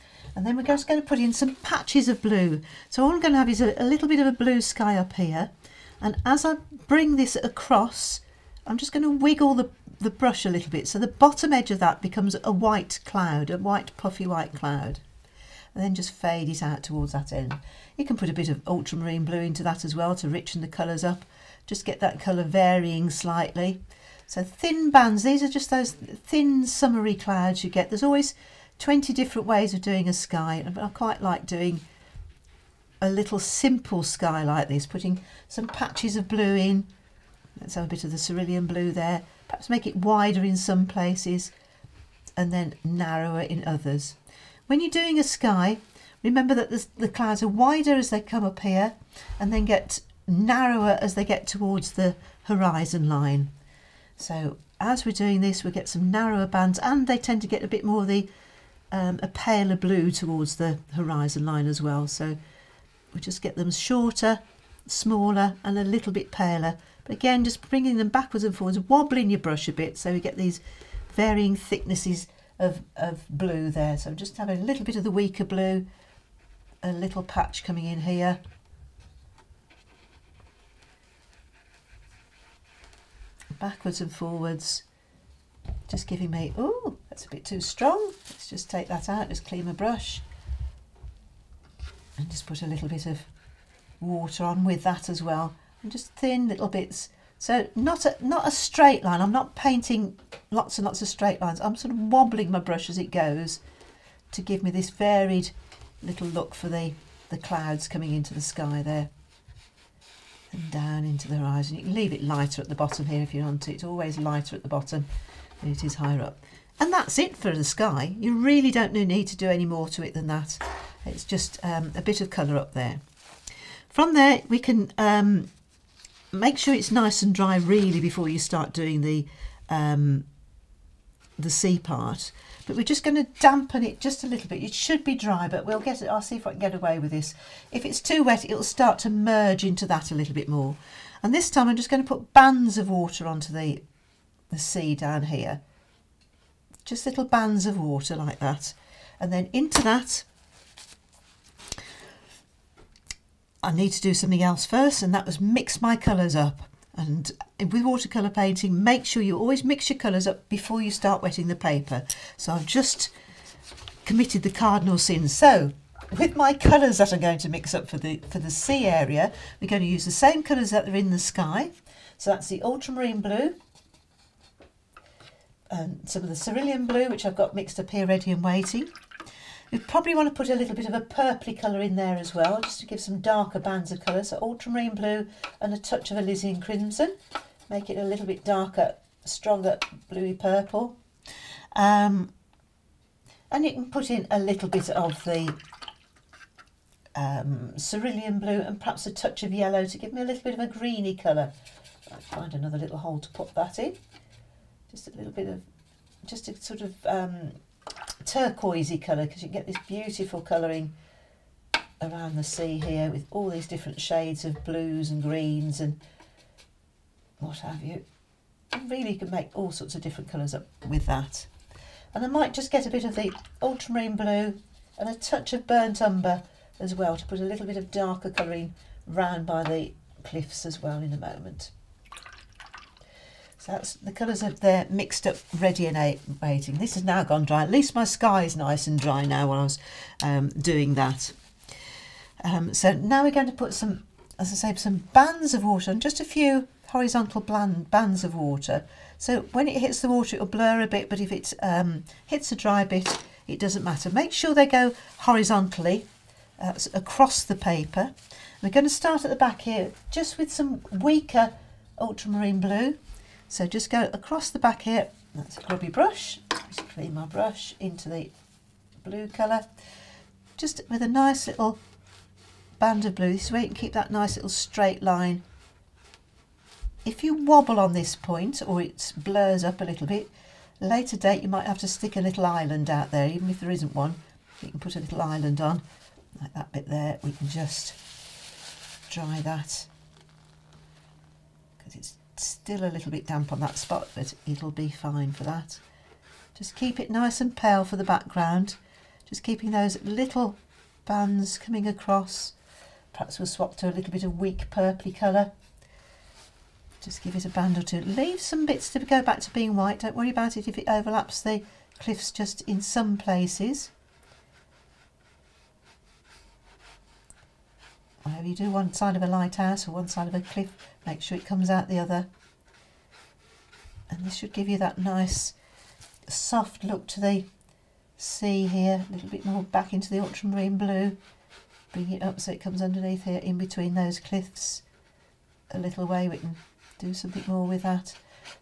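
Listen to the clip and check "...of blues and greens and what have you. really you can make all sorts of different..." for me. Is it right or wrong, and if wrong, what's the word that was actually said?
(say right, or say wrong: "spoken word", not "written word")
right.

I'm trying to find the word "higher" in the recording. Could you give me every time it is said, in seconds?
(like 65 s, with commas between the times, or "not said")
115 s.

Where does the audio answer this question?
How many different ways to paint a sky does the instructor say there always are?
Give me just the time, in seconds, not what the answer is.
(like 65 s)
28 s.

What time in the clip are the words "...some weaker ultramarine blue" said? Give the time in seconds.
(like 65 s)
260 s.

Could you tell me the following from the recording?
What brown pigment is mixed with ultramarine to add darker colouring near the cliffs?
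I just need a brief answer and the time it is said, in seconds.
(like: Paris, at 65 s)
Burnt umber, at 225 s.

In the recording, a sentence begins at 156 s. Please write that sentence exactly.
And with watercolour painting, make sure you always mix your colours up before you start wetting the paper.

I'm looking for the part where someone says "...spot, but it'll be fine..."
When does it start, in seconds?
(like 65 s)
293 s.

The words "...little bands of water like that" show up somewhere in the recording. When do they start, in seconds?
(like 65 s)
147 s.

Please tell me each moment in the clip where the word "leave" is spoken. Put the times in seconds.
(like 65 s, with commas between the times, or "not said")
111 s, 308 s.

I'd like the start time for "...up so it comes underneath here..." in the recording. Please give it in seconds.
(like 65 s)
332 s.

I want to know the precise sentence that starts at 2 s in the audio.
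So all I'm going to have is a, a little bit of a blue sky up here.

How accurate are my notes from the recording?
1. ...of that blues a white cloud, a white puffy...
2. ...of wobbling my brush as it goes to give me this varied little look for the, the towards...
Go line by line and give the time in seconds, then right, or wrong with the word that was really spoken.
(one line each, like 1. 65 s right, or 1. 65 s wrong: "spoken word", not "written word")
1. 11 s wrong: "becomes", not "blues"
2. 101 s wrong: "clouds", not "towards".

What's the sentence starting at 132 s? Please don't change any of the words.
But we're just going to dampen it just a little bit.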